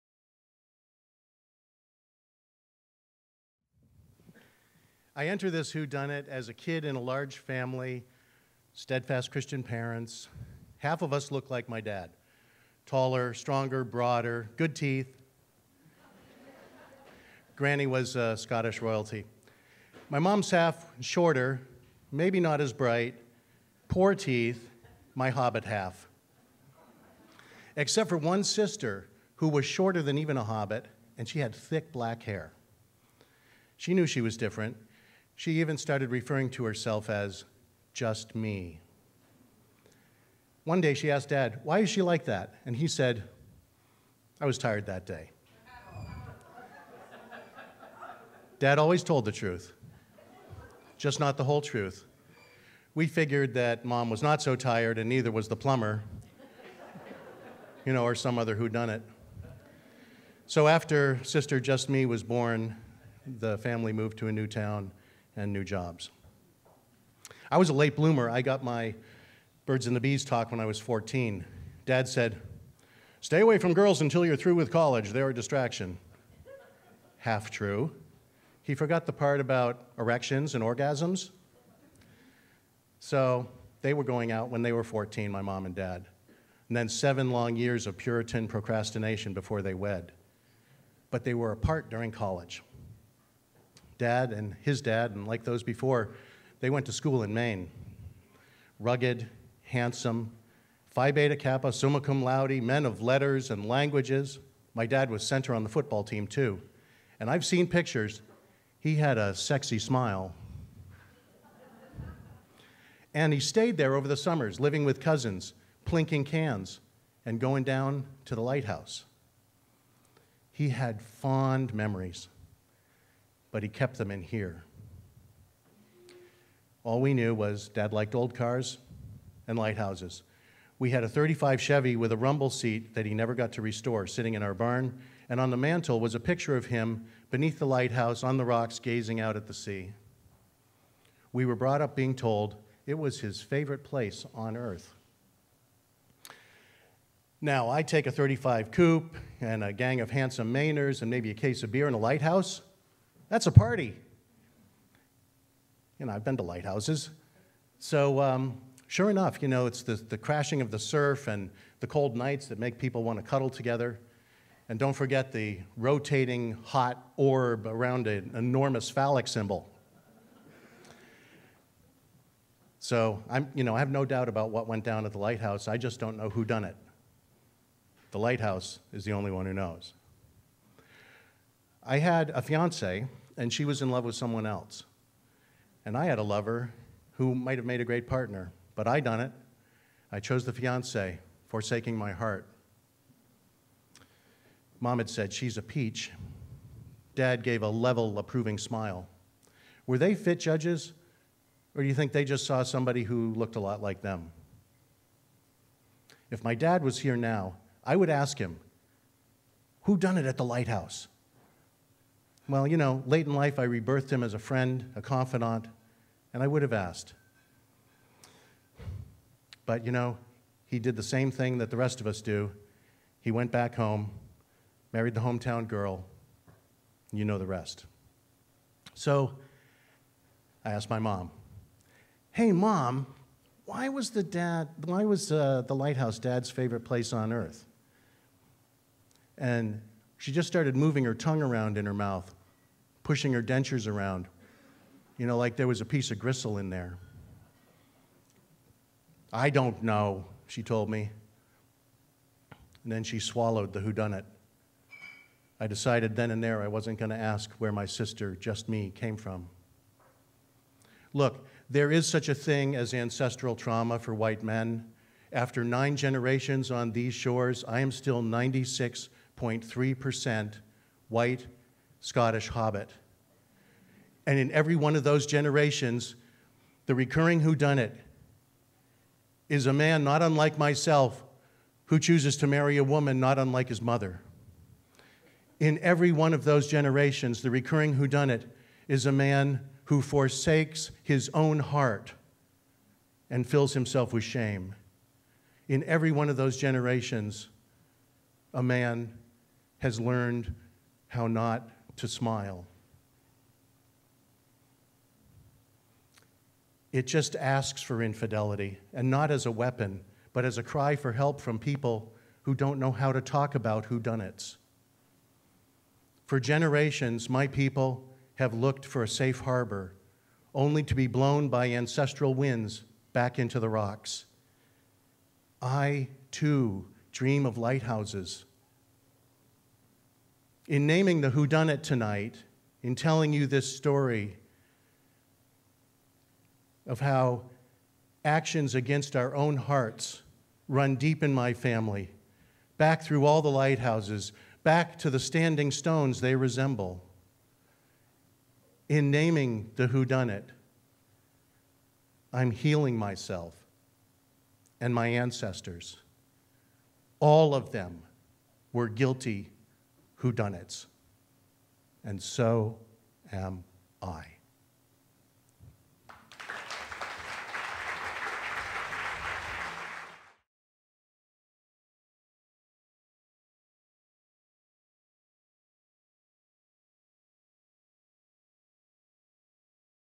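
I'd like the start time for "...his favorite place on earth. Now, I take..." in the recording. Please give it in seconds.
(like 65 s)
143 s.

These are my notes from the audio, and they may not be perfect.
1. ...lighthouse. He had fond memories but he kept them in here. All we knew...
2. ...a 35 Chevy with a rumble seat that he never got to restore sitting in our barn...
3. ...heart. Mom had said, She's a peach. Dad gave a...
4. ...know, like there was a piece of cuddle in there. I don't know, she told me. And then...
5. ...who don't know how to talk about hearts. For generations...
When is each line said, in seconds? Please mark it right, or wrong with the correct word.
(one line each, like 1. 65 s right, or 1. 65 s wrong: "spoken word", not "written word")
1. 118 s right
2. 131 s right
3. 192 s right
4. 245 s wrong: "gristle", not "cuddle"
5. 312 s wrong: "whodunits", not "hearts".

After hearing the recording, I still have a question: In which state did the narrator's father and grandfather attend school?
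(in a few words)
Maine.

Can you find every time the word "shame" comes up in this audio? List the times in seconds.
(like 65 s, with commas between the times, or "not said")
294 s.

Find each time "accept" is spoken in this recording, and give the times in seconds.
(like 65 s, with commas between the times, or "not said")
not said.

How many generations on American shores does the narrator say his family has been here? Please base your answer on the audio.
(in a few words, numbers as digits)
9.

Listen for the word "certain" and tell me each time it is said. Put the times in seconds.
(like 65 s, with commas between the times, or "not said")
not said.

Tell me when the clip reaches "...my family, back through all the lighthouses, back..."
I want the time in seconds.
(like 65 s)
341 s.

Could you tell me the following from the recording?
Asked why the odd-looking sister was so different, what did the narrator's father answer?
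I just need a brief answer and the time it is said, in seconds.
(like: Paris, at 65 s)
I was tired that day, at 44 s.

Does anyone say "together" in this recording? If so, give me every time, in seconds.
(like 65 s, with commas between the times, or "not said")
163 s.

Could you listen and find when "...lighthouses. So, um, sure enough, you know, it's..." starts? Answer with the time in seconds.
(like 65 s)
156 s.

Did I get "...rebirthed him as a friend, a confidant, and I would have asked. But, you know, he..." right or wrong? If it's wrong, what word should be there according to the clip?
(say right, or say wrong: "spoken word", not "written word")
right.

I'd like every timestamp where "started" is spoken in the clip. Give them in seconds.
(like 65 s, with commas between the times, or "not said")
35 s, 240 s.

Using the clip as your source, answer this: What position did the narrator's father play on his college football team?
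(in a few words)
Center.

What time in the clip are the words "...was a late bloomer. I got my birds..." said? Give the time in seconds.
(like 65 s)
67 s.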